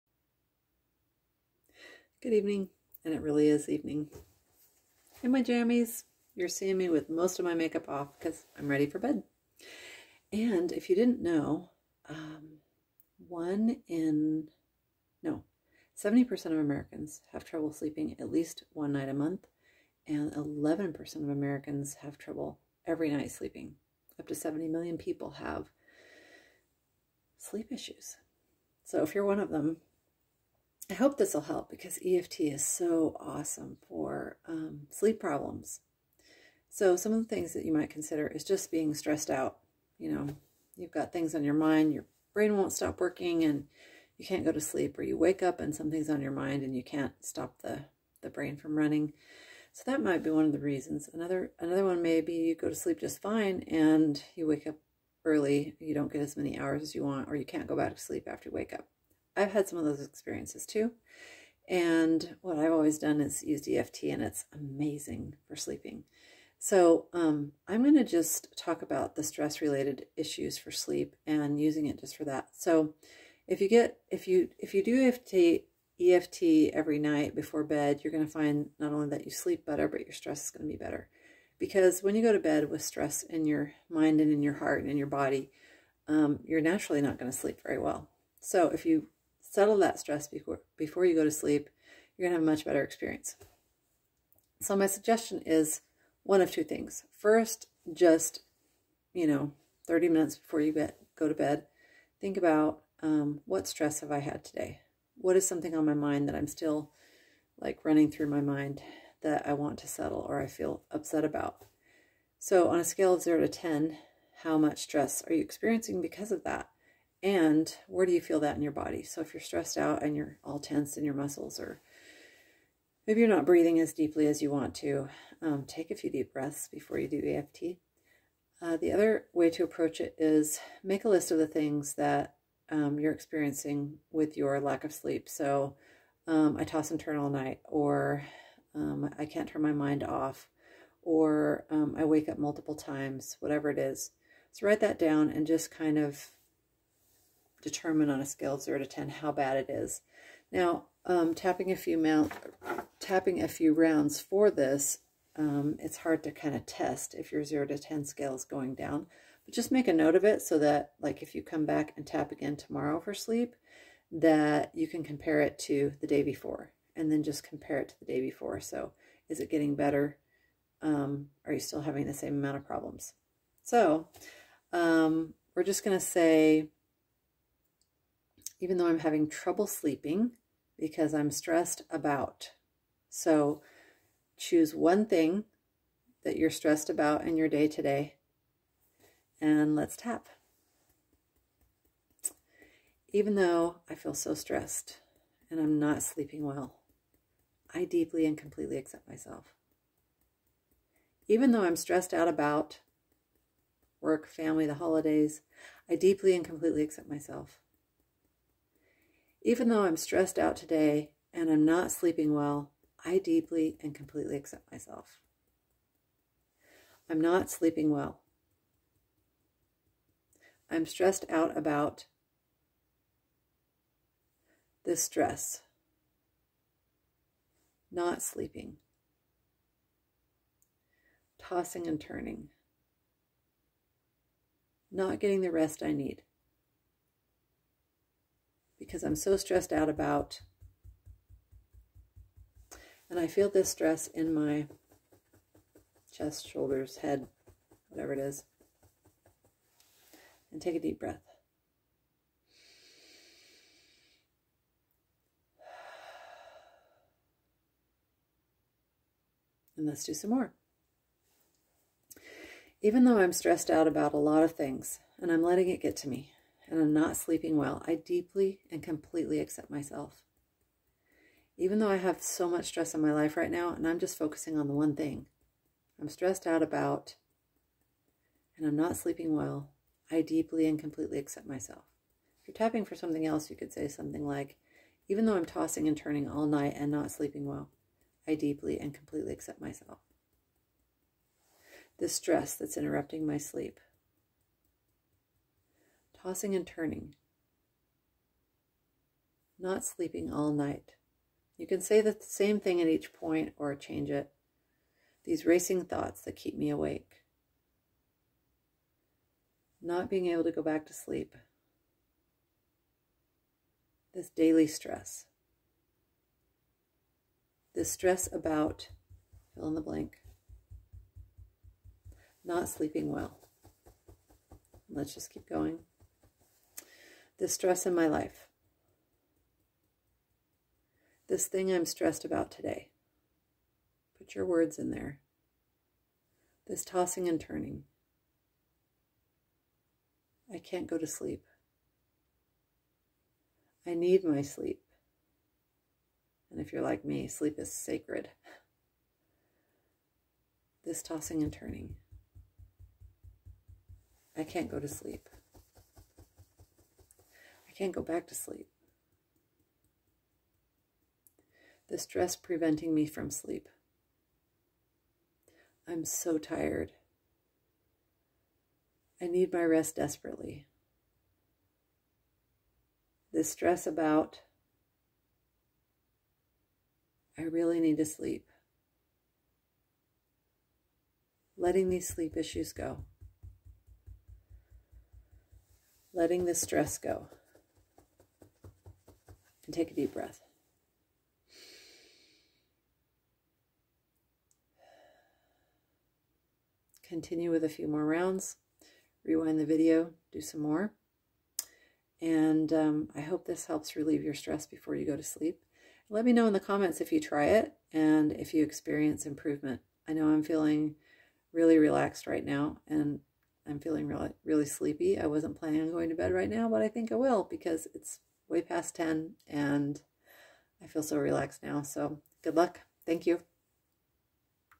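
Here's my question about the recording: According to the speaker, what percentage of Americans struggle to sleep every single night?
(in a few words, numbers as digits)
11%.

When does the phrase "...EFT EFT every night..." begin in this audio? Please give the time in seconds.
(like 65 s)
75 s.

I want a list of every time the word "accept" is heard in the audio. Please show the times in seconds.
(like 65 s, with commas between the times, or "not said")
198 s, 206 s, 214 s, 269 s, 281 s, 289 s.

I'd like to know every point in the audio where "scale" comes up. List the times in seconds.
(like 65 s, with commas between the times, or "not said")
112 s, 148 s, 158 s.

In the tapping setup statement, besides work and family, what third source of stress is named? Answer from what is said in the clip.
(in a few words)
the holidays.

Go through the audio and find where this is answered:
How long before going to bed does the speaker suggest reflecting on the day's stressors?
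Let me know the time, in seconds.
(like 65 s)
99 s.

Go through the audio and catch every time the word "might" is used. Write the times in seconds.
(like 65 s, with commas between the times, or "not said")
37 s, 50 s.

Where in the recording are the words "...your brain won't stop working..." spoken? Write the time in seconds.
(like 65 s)
41 s.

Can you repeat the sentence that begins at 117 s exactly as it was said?
And where do you feel that in your body?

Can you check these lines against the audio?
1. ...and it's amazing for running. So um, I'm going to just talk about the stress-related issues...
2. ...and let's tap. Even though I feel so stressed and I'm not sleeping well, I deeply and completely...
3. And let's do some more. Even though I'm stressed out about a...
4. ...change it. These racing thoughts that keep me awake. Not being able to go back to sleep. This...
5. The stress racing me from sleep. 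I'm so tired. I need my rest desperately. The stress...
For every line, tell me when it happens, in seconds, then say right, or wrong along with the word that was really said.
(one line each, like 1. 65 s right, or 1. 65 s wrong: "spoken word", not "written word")
1. 64 s wrong: "sleeping", not "running"
2. 189 s right
3. 259 s right
4. 303 s right
5. 361 s wrong: "preventing", not "racing".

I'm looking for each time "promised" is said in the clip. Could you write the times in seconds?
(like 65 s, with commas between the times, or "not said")
not said.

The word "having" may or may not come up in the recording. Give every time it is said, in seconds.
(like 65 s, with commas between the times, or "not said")
171 s, 178 s.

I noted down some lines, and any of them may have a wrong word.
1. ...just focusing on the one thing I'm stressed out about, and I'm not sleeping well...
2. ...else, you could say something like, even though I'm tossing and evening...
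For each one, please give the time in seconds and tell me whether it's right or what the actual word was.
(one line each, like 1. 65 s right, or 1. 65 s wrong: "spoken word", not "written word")
1. 273 s right
2. 283 s wrong: "turning", not "evening".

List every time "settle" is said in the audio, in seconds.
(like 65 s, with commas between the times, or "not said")
89 s, 109 s.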